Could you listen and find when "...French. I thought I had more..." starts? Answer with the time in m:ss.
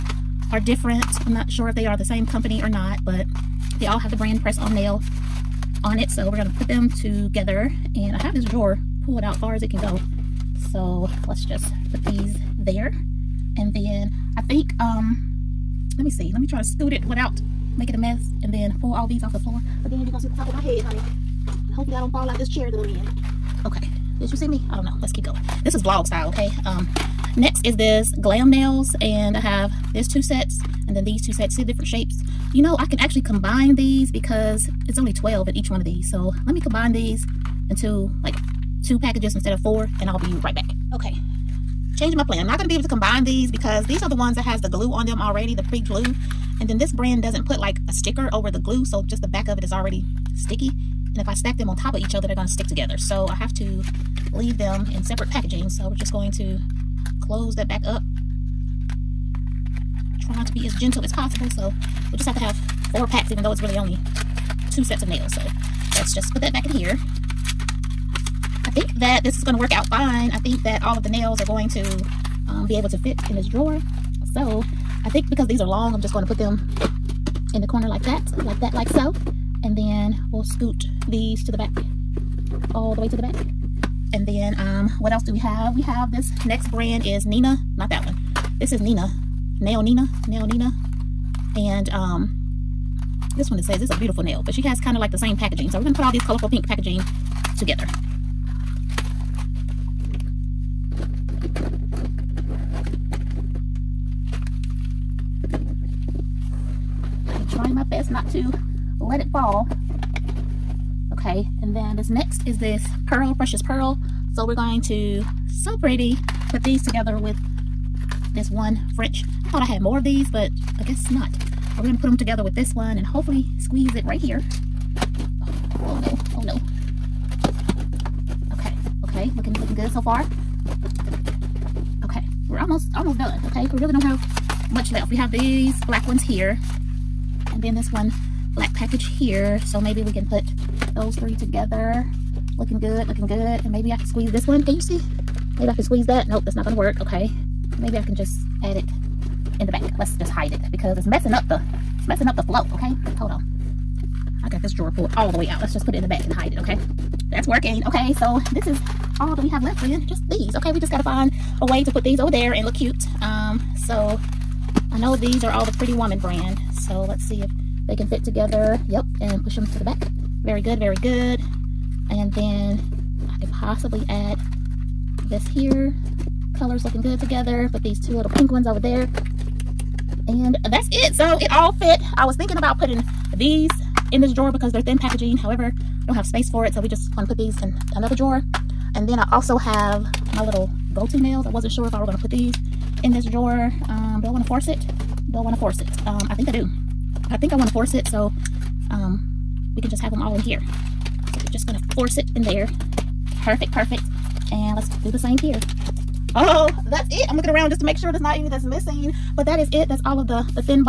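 1:58.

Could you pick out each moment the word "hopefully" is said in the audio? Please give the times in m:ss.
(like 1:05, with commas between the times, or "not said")
0:21, 2:03.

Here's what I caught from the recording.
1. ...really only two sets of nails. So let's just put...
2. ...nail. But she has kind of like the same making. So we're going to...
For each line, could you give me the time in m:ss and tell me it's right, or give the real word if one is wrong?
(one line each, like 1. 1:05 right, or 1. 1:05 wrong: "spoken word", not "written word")
1. 1:03 right
2. 1:34 wrong: "packaging", not "making".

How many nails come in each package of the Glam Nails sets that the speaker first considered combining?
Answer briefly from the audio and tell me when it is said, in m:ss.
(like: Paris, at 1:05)
12, at 0:35.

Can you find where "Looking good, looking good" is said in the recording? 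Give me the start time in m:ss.
2:22.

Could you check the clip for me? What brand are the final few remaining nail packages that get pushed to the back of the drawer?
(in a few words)
Pretty Woman.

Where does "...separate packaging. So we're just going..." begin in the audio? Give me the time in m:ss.
0:55.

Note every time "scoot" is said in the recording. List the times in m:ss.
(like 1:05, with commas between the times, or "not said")
0:16, 1:20.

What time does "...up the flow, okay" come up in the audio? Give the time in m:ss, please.
2:32.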